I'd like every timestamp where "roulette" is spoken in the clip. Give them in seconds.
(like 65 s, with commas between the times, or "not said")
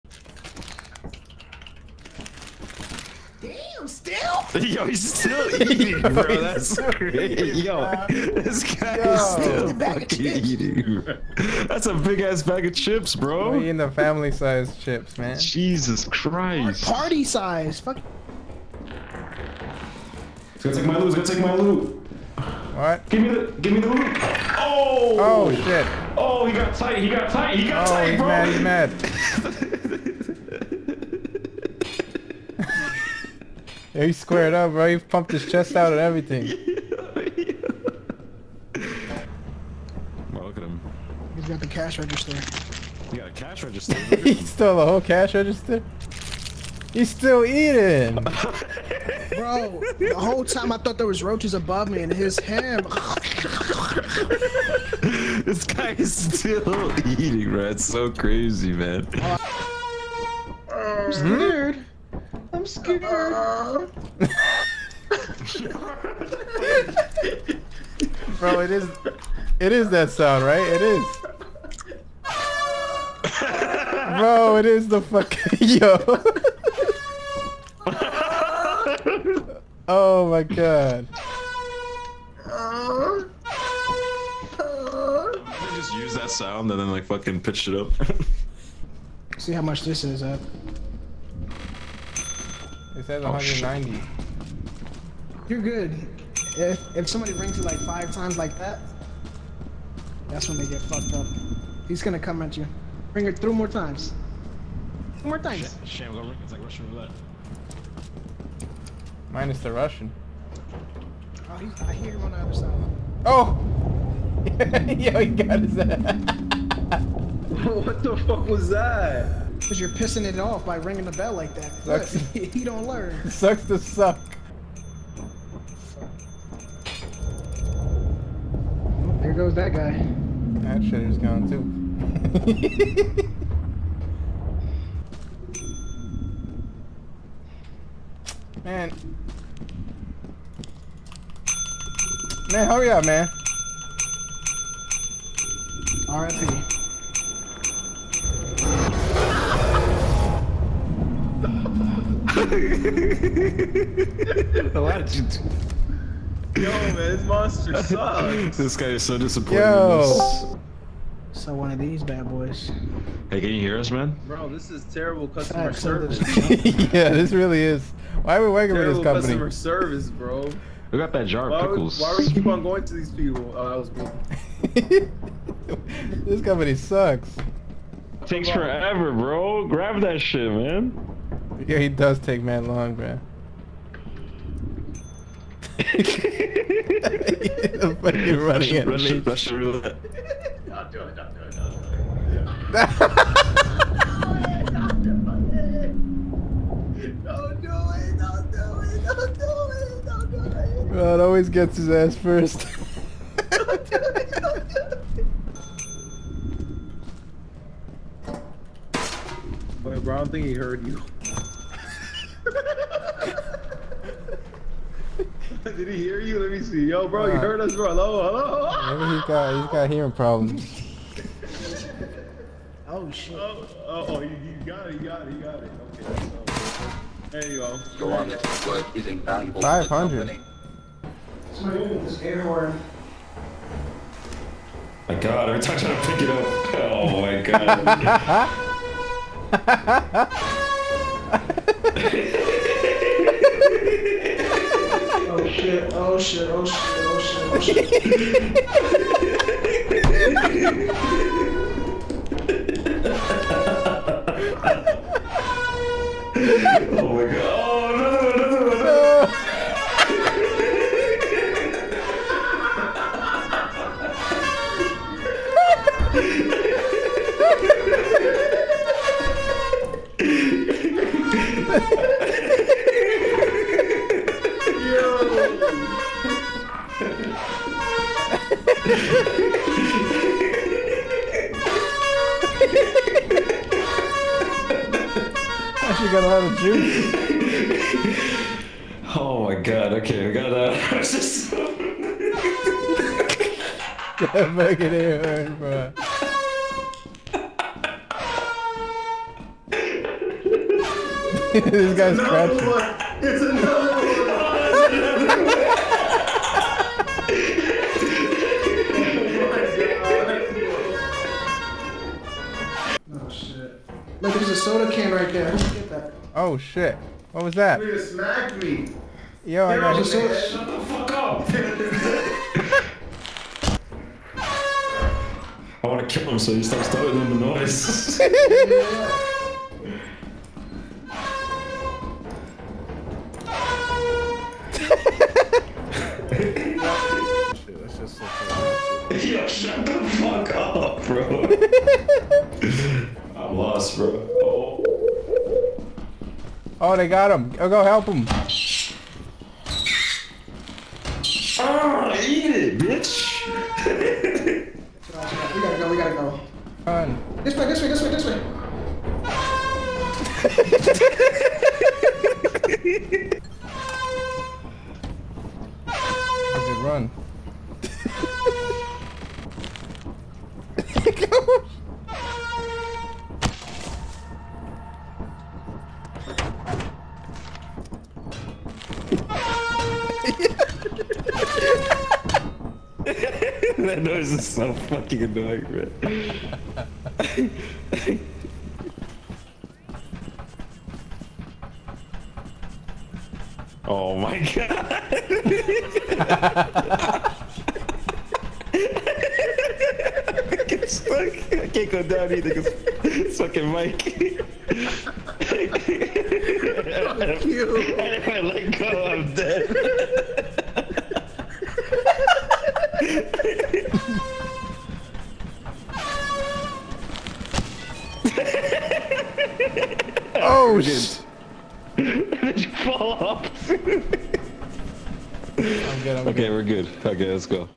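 106 s, 189 s.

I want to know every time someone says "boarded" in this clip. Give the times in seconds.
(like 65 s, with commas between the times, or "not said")
not said.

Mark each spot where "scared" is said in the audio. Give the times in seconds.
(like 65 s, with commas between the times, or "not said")
62 s.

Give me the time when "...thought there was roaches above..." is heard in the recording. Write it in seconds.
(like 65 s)
50 s.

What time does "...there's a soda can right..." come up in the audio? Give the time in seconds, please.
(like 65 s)
314 s.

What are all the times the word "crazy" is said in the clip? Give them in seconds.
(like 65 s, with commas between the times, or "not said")
6 s, 58 s.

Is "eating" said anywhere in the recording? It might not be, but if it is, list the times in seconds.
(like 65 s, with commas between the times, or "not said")
5 s, 10 s, 47 s, 57 s.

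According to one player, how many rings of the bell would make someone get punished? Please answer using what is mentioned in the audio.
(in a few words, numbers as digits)
5.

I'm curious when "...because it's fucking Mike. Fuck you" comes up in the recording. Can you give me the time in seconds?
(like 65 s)
402 s.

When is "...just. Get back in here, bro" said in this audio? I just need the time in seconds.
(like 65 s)
291 s.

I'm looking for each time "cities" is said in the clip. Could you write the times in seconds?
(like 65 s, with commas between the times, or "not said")
not said.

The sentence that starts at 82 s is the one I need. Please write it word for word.
I just use that sound and then like fucking pitched it up.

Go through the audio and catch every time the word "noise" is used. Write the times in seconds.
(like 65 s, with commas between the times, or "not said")
327 s, 384 s.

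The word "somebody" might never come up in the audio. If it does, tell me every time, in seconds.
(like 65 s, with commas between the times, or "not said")
97 s.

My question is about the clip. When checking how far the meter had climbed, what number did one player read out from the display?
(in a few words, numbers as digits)
190.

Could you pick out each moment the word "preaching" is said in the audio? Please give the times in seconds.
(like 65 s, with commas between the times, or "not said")
not said.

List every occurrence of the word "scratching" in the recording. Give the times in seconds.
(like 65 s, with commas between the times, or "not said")
302 s.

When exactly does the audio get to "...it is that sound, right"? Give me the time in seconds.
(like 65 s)
69 s.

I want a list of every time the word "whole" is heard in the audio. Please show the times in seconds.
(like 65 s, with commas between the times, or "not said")
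44 s, 50 s.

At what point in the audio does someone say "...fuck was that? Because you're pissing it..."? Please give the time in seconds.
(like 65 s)
118 s.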